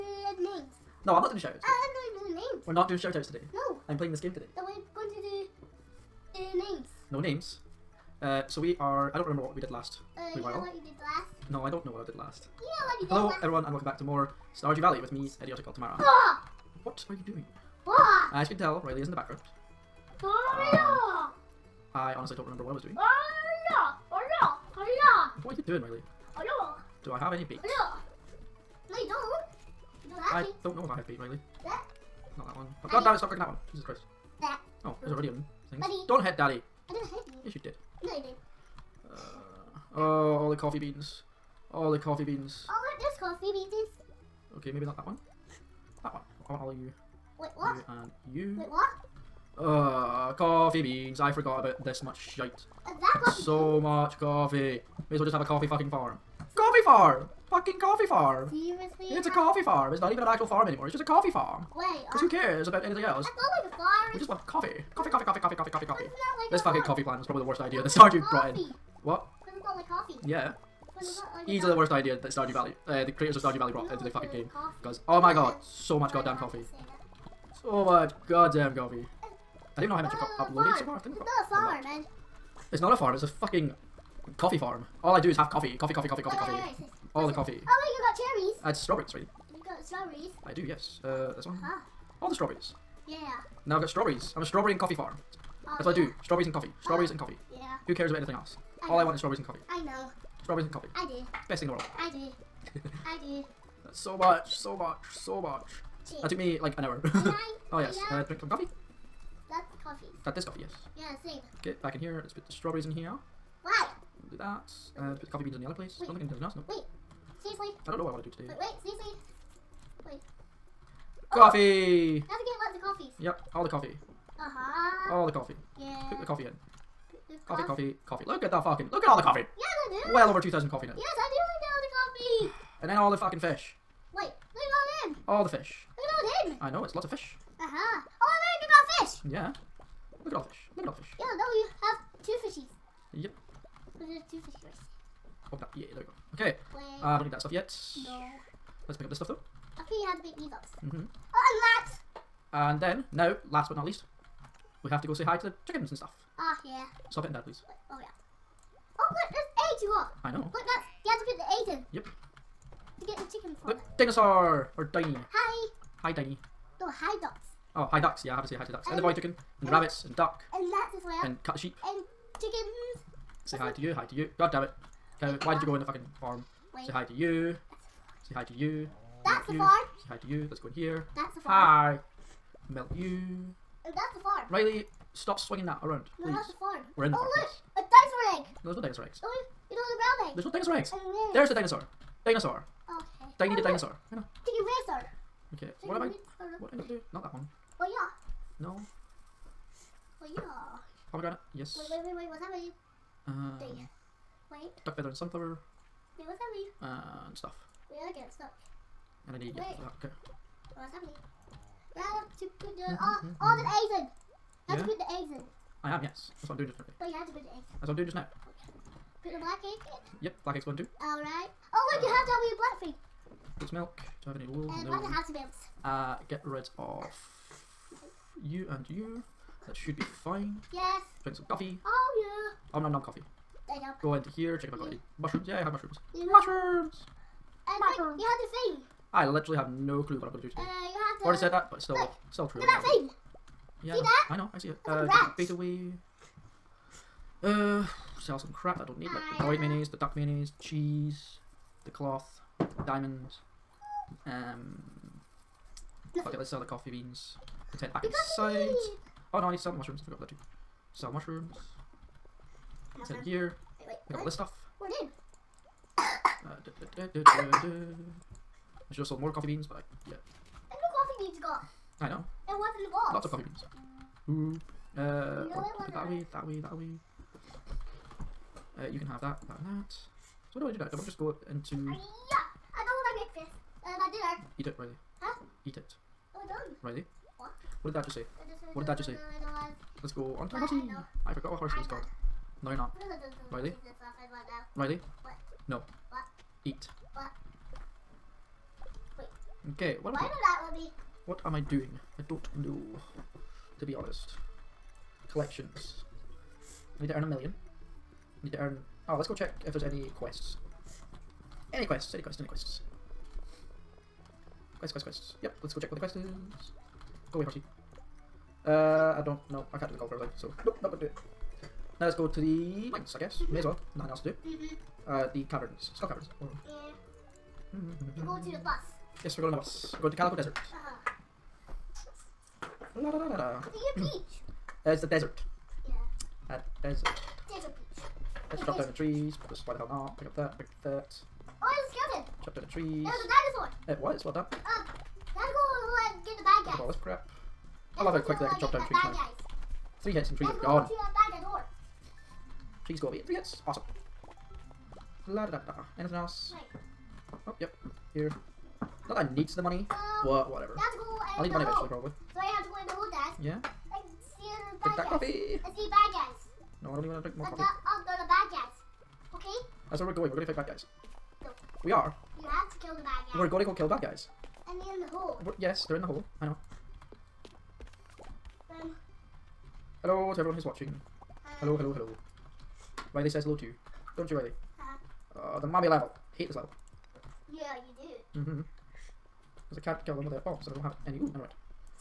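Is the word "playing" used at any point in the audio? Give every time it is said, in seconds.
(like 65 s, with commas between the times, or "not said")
3 s.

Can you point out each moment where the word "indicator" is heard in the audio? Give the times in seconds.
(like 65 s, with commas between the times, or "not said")
not said.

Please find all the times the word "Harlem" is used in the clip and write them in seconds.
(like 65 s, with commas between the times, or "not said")
not said.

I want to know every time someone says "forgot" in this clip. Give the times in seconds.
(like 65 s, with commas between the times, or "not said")
51 s, 260 s, 291 s.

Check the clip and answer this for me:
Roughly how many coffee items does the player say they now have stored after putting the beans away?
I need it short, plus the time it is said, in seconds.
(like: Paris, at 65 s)
over 2,000, at 130 s.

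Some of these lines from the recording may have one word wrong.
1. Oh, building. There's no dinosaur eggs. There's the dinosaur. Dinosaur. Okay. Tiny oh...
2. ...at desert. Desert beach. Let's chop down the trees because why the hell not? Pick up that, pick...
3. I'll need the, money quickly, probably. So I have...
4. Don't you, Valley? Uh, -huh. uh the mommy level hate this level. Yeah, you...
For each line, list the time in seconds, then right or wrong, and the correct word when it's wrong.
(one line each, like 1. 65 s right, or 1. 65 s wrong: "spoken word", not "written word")
1. 189 s right
2. 336 s right
3. 361 s wrong: "eventually", not "quickly"
4. 384 s wrong: "Riley", not "Valley".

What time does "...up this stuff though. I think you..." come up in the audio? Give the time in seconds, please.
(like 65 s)
149 s.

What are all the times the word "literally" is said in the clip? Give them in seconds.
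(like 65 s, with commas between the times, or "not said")
239 s.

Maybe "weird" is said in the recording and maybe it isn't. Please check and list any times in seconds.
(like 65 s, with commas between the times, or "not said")
222 s.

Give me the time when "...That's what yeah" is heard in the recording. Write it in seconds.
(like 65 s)
95 s.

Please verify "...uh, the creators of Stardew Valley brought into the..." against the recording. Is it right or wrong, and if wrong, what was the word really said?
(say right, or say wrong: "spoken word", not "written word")
right.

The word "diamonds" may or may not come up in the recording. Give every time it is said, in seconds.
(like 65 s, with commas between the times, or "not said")
252 s.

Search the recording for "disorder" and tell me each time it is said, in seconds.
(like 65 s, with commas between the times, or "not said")
not said.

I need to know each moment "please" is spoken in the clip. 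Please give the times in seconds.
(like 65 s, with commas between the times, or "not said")
157 s, 186 s, 352 s.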